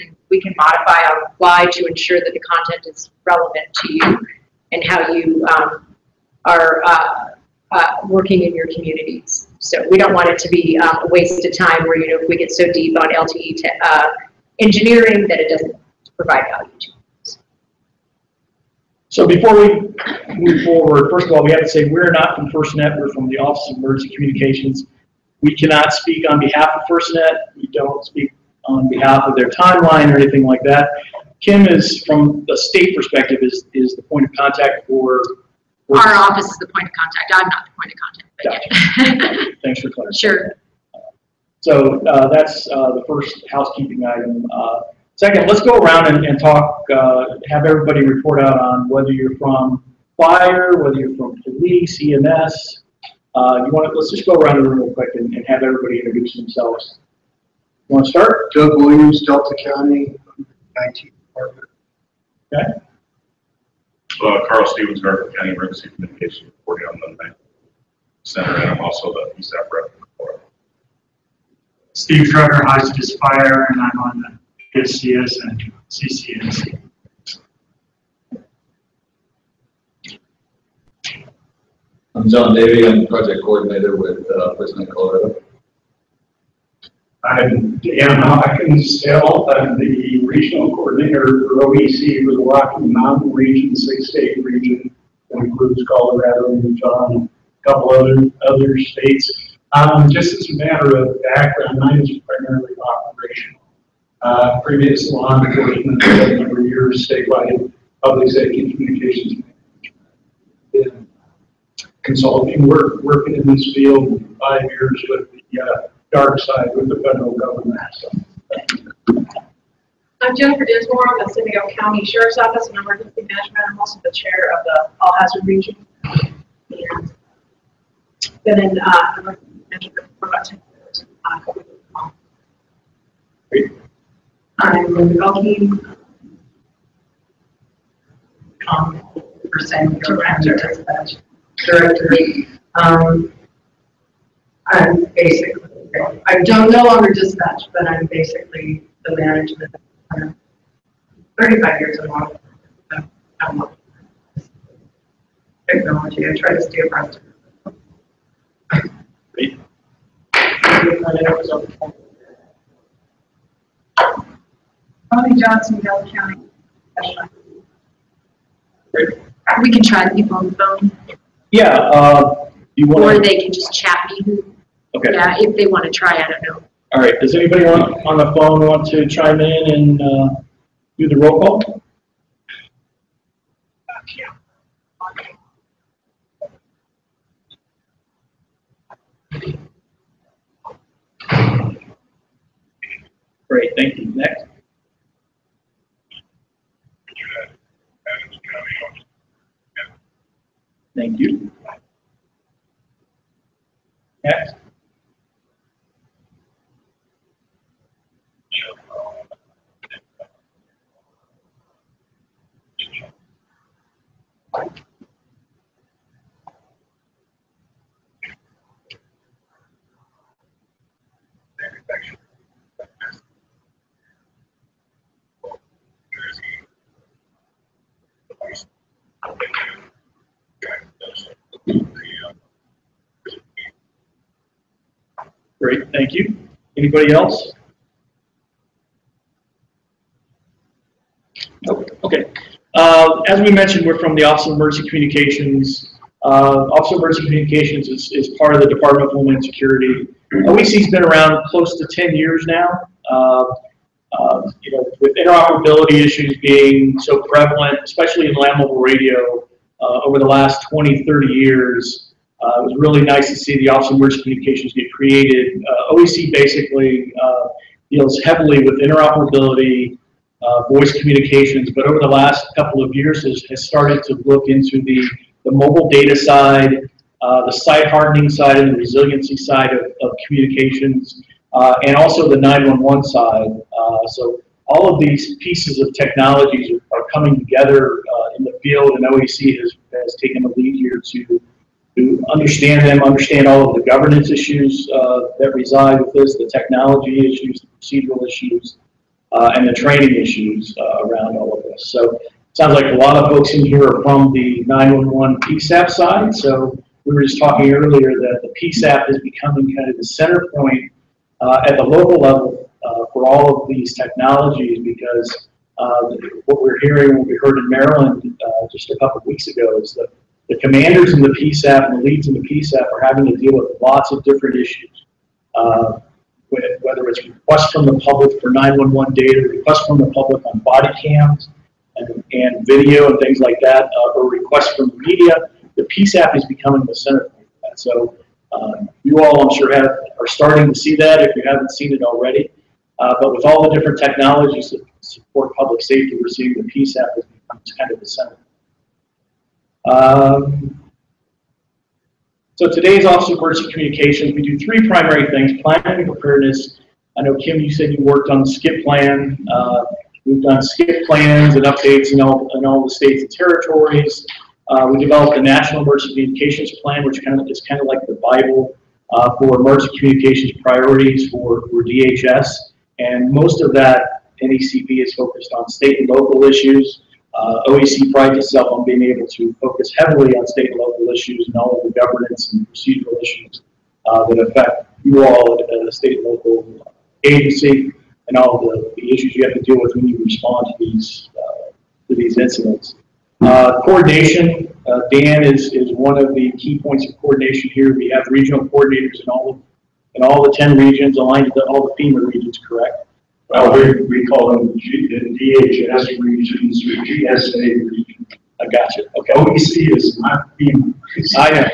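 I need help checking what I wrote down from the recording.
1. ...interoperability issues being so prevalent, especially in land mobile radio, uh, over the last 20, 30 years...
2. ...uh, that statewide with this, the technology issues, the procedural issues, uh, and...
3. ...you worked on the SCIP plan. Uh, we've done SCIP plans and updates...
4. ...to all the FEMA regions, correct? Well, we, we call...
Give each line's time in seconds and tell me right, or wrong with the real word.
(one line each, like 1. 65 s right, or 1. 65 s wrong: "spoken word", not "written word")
1. 255 s right
2. 294 s wrong: "reside", not "statewide"
3. 357 s right
4. 401 s right.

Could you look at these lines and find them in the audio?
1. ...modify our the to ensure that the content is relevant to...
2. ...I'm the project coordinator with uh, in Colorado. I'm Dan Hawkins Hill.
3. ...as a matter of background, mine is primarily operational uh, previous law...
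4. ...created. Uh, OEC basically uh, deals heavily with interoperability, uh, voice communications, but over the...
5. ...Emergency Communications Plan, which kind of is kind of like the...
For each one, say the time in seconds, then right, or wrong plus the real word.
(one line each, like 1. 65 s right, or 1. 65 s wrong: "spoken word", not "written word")
1. 0 s right
2. 82 s right
3. 100 s right
4. 264 s right
5. 365 s right.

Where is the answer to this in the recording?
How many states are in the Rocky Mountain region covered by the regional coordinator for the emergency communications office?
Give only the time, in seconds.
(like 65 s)
93 s.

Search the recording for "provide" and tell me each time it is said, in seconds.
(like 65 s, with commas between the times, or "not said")
16 s.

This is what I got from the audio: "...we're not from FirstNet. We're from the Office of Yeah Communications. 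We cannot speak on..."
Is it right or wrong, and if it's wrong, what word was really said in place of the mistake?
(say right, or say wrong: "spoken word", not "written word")
wrong: "Emergency", not "Yeah".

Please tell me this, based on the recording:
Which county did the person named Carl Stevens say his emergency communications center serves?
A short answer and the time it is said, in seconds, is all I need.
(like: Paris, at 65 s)
Garfield County, at 65 s.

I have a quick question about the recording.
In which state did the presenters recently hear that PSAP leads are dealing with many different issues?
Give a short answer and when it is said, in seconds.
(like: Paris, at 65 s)
Maryland, at 317 s.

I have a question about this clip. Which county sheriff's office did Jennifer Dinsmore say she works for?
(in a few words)
San Diego County.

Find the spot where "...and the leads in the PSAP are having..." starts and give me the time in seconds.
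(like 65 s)
321 s.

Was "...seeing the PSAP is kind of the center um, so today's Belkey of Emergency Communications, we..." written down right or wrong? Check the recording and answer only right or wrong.
wrong.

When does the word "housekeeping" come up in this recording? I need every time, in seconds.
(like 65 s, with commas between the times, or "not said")
43 s.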